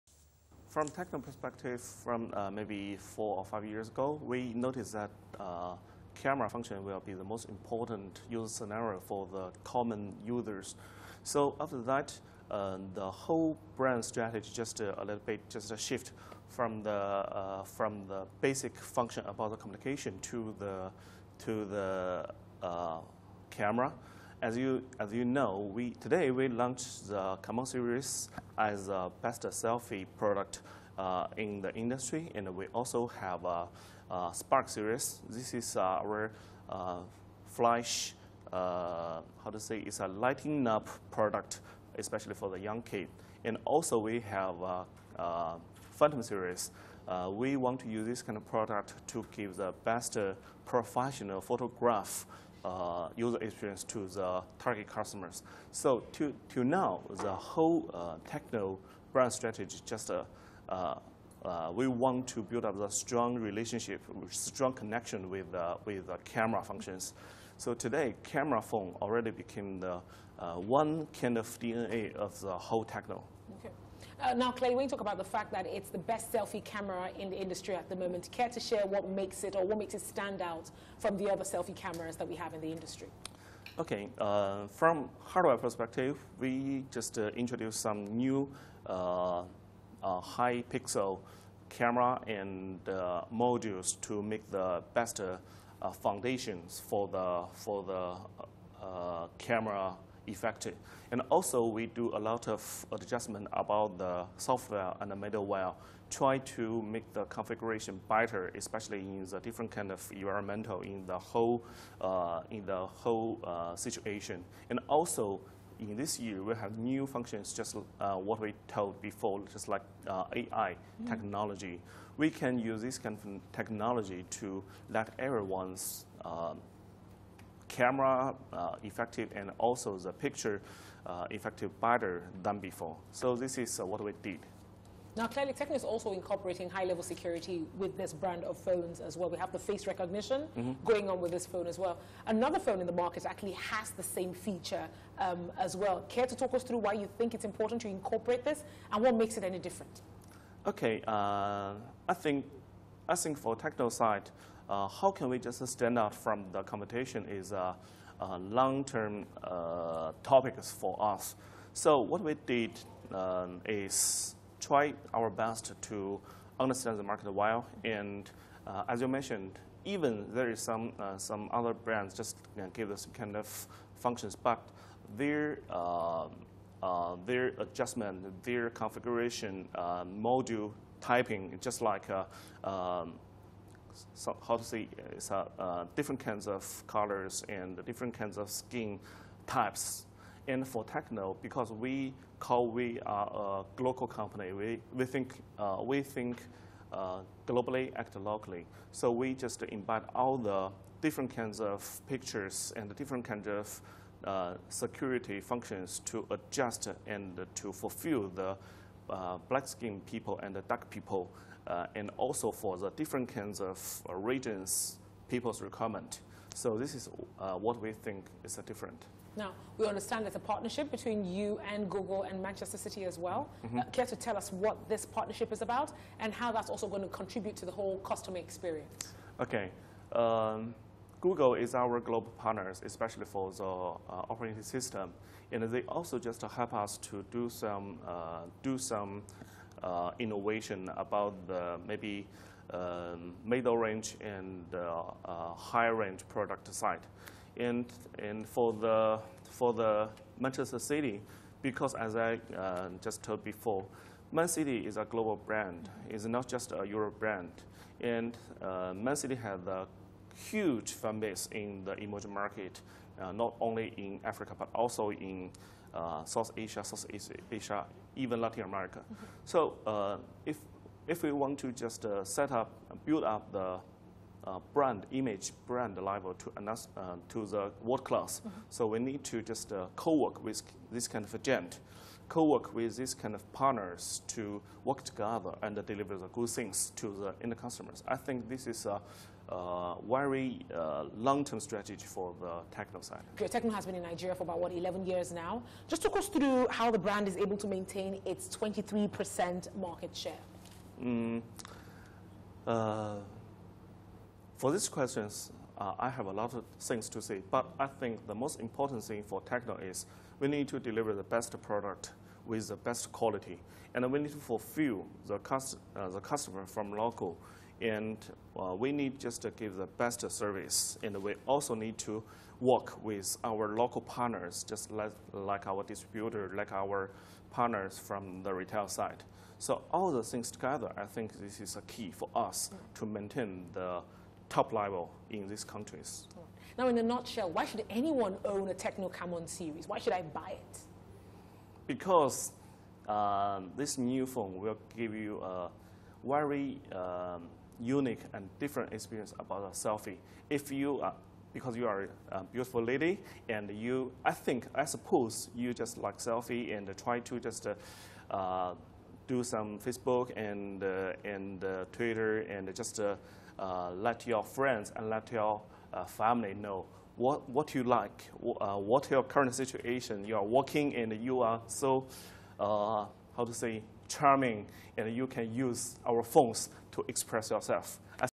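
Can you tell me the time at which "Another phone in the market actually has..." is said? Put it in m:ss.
2:22.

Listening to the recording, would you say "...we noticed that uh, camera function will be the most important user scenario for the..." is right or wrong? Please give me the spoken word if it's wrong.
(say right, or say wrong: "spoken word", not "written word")
right.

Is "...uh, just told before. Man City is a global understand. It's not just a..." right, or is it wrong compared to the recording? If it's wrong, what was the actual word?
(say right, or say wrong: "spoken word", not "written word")
wrong: "brand", not "understand".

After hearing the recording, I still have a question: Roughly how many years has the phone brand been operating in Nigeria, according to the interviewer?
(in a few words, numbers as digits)
11.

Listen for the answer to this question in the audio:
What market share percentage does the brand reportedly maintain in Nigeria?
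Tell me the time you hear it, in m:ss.
4:58.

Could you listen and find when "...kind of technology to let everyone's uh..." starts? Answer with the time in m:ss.
2:02.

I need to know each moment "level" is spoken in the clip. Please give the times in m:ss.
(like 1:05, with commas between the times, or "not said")
2:16, 4:35, 5:34.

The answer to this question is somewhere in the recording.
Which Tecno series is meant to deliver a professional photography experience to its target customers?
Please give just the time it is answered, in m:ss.
0:45.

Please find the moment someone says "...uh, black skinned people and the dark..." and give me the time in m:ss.
3:29.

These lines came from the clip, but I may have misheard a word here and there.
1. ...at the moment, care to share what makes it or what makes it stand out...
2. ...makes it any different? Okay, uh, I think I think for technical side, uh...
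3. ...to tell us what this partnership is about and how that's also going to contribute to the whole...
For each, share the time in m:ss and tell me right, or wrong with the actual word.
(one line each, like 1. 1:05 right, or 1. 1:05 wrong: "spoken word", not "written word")
1. 1:17 right
2. 2:29 right
3. 3:44 right.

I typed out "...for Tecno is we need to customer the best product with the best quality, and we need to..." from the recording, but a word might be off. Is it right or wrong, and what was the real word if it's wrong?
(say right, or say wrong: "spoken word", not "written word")
wrong: "deliver", not "customer".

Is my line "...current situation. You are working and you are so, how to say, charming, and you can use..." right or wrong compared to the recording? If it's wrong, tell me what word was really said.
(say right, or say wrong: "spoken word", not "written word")
right.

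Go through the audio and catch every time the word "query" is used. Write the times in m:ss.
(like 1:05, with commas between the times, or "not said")
not said.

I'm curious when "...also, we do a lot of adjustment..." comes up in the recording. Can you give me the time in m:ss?
1:41.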